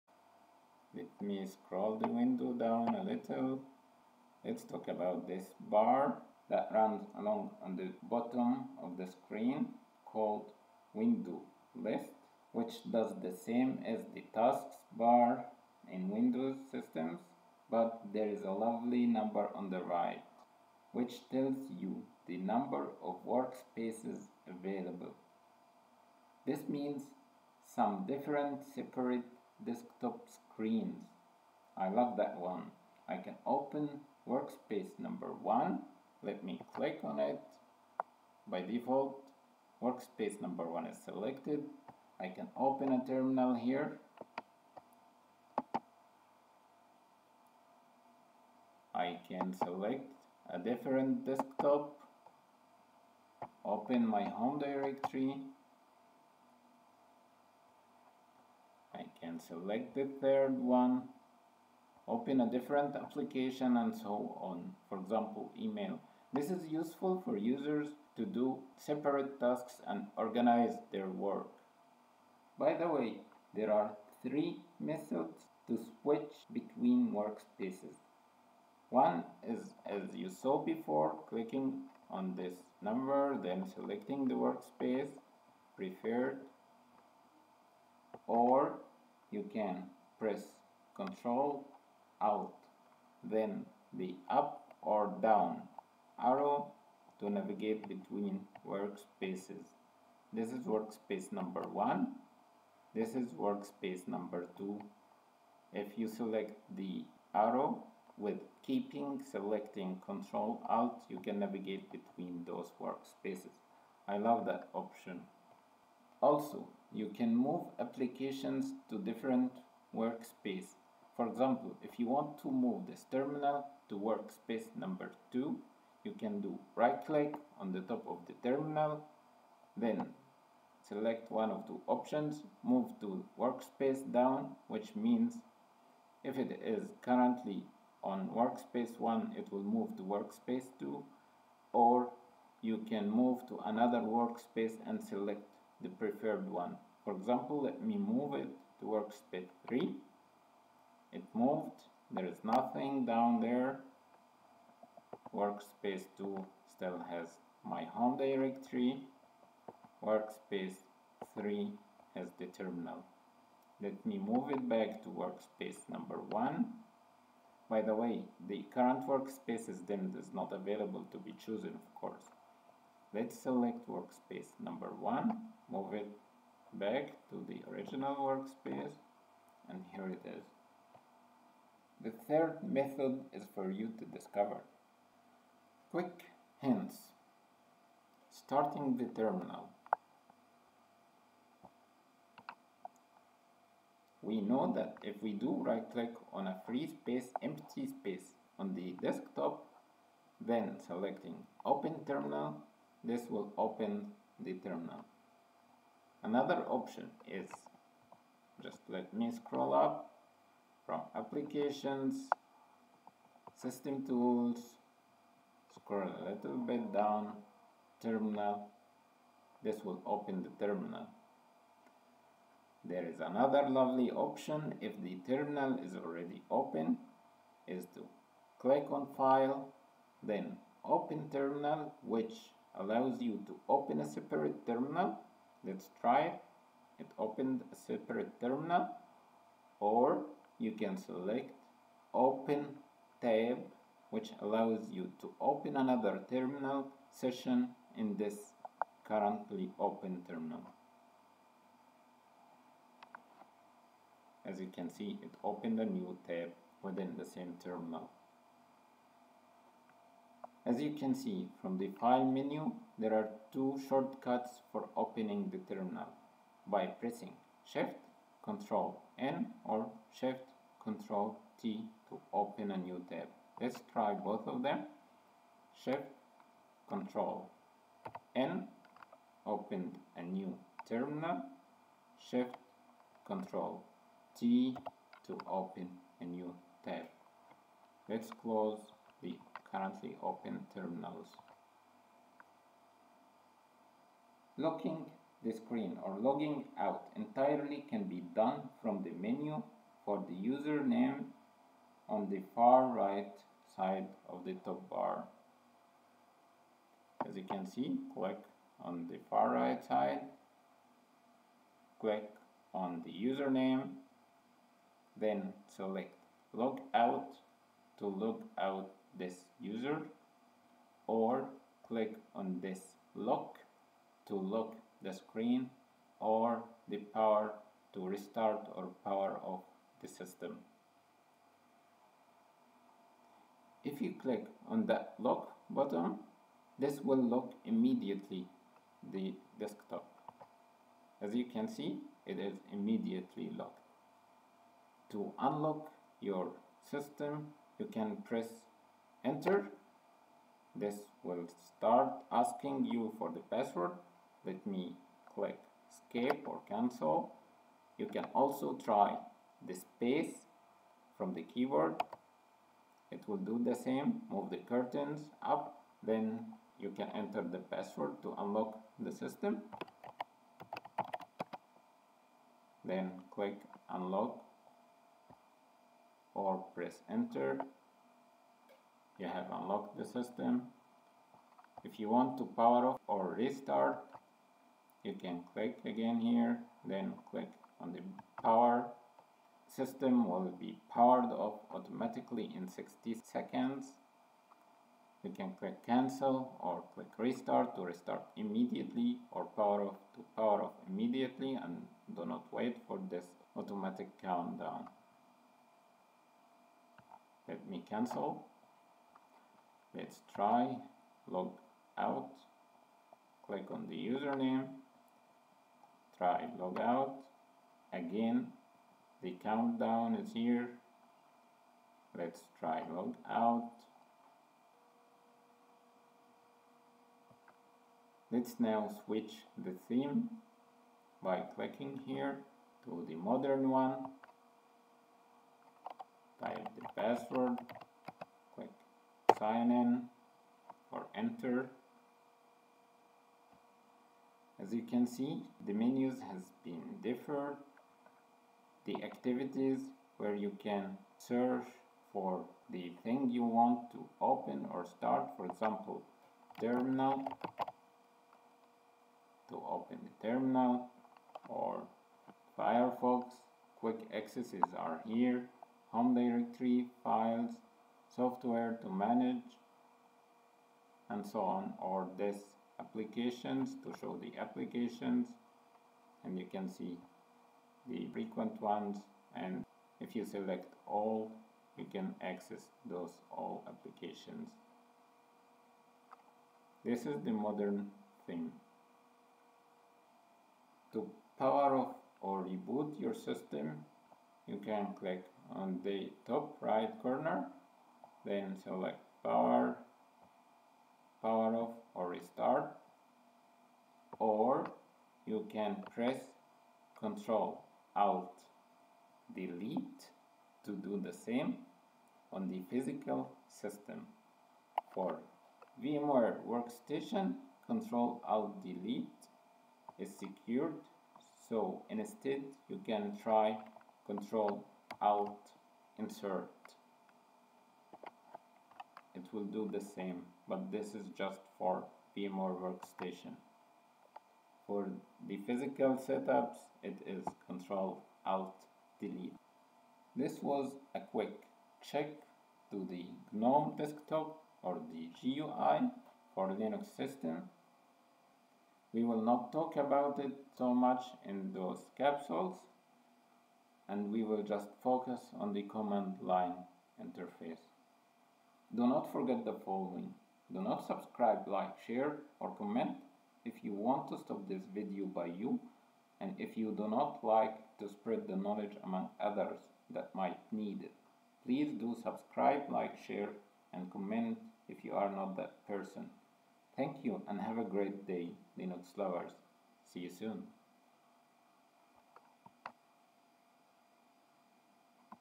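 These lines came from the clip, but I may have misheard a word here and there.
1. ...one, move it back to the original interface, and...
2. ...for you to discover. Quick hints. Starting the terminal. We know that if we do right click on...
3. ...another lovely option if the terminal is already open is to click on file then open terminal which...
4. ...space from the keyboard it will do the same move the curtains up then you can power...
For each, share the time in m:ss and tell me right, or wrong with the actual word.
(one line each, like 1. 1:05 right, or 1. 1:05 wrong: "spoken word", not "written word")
1. 2:54 wrong: "workspace", not "interface"
2. 3:03 right
3. 3:43 right
4. 5:59 wrong: "enter", not "power".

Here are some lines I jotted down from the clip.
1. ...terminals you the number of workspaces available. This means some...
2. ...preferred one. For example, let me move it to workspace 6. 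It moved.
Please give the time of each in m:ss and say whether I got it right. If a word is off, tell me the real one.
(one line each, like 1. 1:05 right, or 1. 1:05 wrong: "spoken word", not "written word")
1. 0:21 wrong: "tells", not "terminals"
2. 2:25 wrong: "3", not "6".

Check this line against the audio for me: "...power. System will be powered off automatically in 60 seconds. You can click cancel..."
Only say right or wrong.
right.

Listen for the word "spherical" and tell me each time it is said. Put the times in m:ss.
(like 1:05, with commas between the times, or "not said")
not said.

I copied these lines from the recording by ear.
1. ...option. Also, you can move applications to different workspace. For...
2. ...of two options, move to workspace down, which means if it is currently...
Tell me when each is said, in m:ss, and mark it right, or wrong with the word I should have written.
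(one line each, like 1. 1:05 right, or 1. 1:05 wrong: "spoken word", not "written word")
1. 1:54 right
2. 2:11 right.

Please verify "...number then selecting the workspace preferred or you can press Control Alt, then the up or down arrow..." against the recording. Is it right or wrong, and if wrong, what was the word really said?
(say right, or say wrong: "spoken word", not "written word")
right.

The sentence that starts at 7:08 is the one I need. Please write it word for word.
Let's now switch the theme by clicking here to the modern one.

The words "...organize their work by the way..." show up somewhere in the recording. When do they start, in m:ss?
1:10.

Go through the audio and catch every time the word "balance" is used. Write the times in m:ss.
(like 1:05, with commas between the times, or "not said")
not said.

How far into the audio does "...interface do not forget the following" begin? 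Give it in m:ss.
9:17.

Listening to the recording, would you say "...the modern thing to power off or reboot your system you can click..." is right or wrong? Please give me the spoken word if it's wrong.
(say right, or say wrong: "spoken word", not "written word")
right.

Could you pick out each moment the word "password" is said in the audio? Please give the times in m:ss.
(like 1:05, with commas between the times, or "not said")
5:53, 6:07, 7:17.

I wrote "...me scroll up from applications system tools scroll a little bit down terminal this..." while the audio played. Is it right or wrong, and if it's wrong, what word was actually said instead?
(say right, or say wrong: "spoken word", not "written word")
right.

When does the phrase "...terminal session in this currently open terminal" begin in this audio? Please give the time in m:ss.
4:06.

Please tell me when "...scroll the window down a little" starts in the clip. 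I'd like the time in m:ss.
0:01.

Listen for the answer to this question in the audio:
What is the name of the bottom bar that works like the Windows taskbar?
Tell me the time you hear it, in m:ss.
0:10.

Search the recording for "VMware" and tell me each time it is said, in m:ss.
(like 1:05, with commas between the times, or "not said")
8:35, 8:52.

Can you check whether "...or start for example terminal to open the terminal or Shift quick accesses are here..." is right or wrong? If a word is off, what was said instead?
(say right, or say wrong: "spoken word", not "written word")
wrong: "Firefox", not "Shift".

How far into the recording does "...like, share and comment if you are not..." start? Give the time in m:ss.
9:32.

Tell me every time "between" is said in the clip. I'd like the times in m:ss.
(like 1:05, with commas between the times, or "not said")
1:16, 1:37, 1:51.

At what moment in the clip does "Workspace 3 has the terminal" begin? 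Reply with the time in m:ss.
2:40.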